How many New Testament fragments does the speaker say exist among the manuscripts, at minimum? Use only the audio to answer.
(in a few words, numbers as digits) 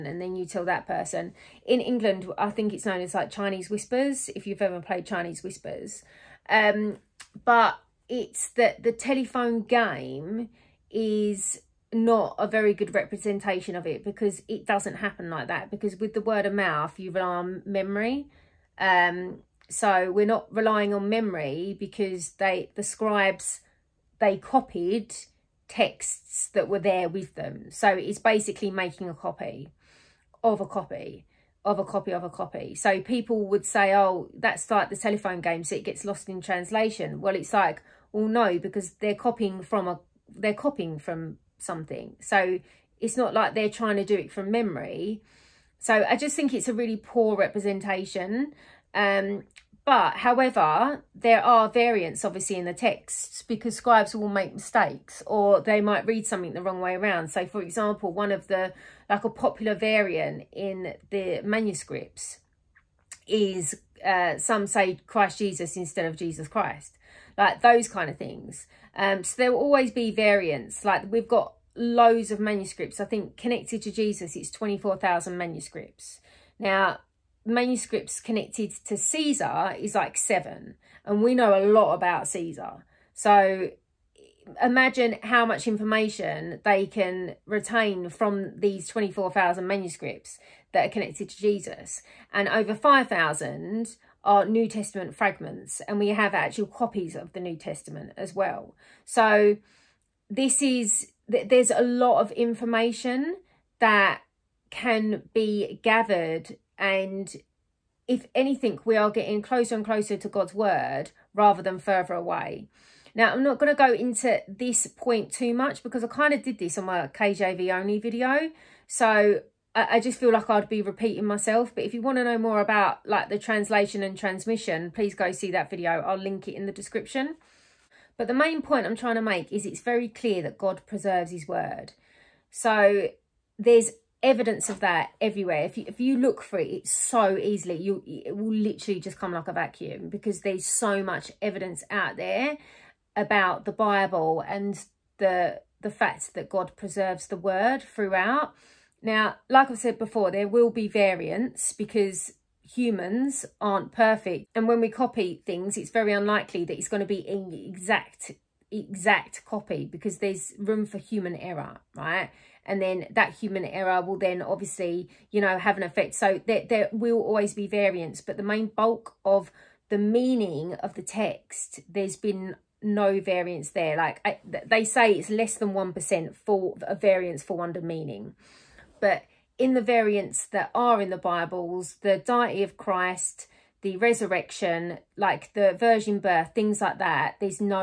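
over 5,000.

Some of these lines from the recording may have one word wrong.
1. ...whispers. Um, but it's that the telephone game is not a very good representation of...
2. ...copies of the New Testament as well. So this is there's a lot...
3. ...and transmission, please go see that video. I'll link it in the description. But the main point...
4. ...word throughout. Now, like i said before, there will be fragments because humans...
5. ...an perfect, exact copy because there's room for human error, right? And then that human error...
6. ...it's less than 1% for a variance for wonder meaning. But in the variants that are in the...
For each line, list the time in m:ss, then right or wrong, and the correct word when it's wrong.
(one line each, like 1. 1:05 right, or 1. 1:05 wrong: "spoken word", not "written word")
1. 0:05 right
2. 1:36 right
3. 2:04 right
4. 2:27 wrong: "variants", not "fragments"
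5. 2:37 wrong: "exact", not "perfect"
6. 2:55 right.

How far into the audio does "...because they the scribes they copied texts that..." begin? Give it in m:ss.
0:21.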